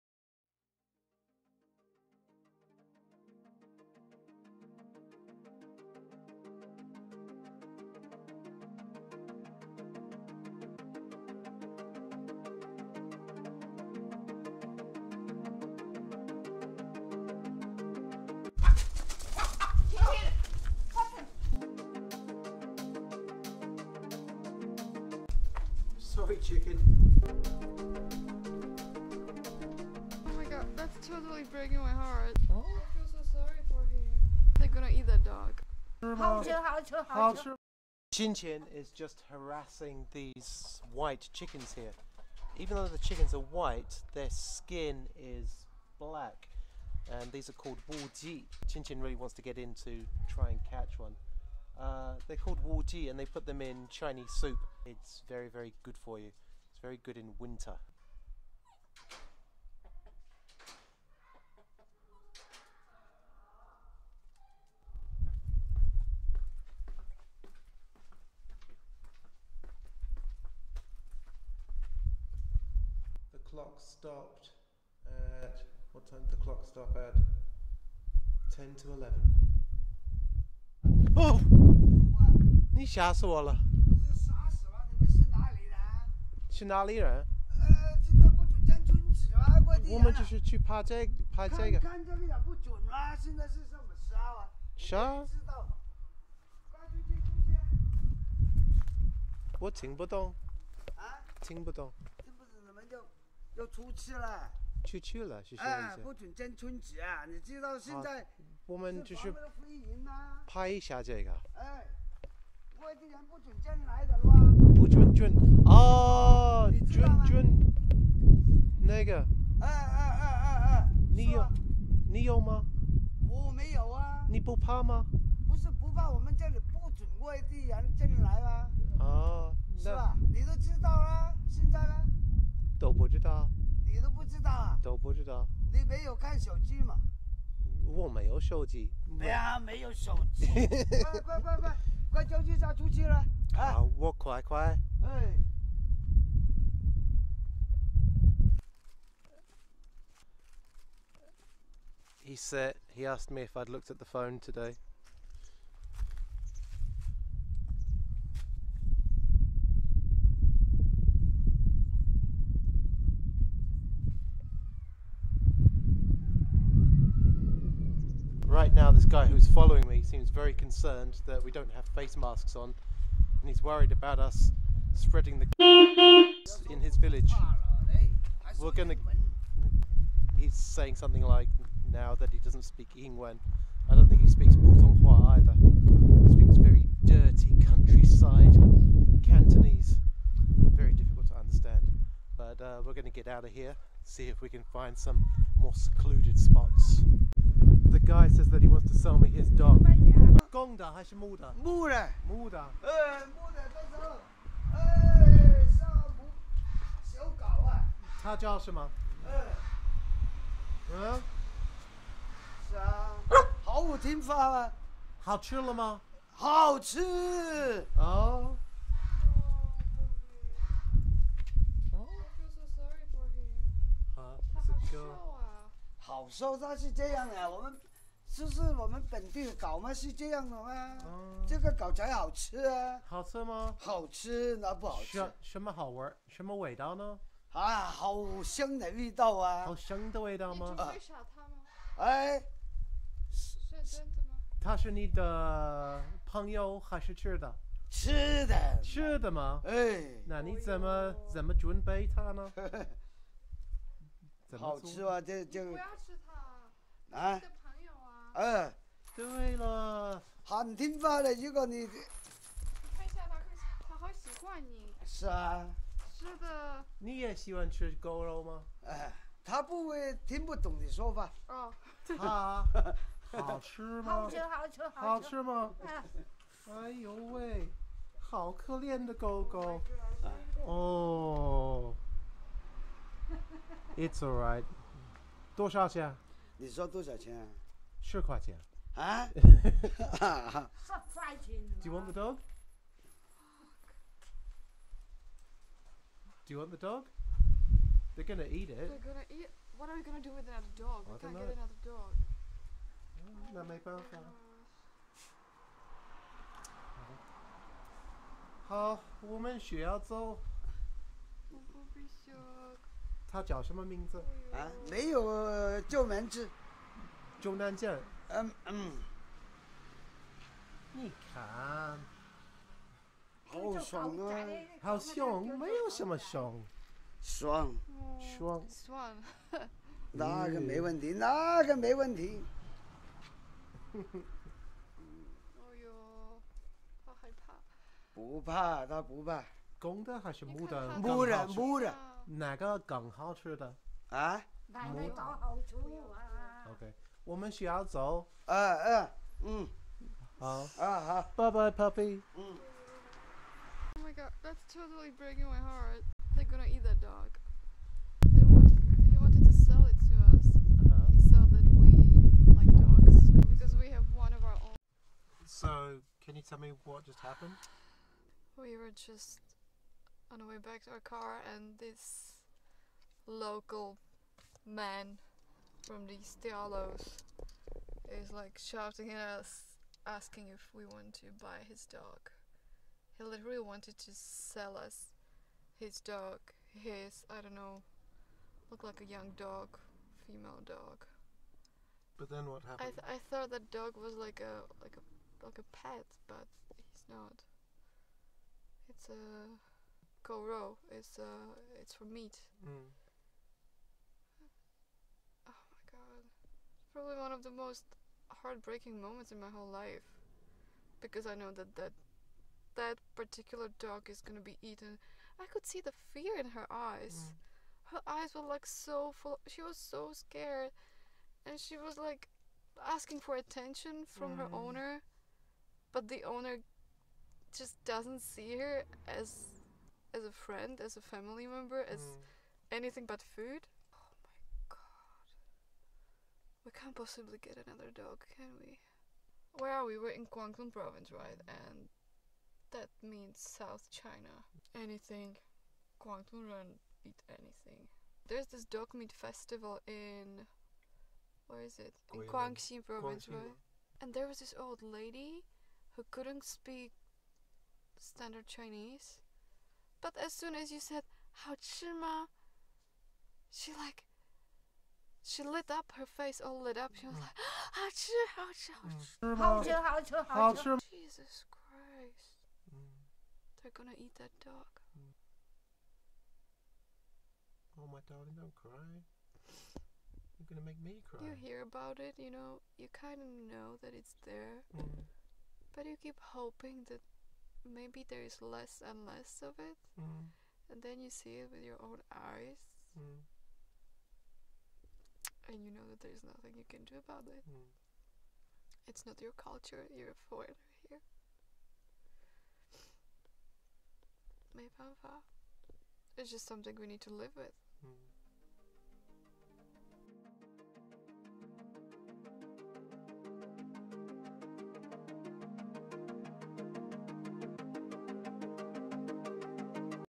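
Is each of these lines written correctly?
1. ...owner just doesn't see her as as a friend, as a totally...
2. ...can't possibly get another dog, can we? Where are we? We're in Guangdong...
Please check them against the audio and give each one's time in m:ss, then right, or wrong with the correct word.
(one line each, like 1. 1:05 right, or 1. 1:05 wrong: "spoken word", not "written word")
1. 7:06 wrong: "family", not "totally"
2. 7:16 right.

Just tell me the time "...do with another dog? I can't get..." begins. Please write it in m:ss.
5:00.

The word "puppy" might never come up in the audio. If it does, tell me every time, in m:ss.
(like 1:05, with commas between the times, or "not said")
5:51.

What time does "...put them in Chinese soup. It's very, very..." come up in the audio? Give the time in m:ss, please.
0:53.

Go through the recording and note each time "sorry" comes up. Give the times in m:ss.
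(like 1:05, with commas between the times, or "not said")
0:33.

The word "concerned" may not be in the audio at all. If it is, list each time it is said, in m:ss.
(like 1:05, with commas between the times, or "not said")
2:50.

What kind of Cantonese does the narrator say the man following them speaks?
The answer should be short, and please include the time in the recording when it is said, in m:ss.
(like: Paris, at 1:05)
dirty countryside Cantonese, at 3:06.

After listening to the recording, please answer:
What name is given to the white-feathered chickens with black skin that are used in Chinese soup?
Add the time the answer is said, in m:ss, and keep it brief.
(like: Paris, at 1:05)
Wu Ji, at 0:47.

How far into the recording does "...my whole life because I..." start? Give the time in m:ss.
6:49.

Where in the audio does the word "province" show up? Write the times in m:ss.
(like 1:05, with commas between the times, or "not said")
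7:20, 7:32.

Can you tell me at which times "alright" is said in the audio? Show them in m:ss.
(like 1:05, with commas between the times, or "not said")
4:44.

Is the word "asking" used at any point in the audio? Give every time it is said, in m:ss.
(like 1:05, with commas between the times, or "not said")
6:20, 7:02.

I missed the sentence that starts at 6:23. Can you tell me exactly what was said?
He literally wanted to sell us his dog, his, I don't know, looked like a young dog, female dog.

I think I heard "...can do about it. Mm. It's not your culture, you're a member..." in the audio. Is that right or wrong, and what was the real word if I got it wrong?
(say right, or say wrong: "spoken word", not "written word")
wrong: "foreigner", not "member".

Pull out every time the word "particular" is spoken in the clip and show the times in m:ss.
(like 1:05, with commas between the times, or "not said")
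6:53.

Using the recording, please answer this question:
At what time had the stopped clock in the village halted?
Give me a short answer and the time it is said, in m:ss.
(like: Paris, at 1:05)
10 to 11, at 1:18.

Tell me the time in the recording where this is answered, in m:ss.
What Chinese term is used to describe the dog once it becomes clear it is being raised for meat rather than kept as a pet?
6:38.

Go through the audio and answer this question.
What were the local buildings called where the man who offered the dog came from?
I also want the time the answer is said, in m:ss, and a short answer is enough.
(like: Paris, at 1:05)
diaolous, at 6:11.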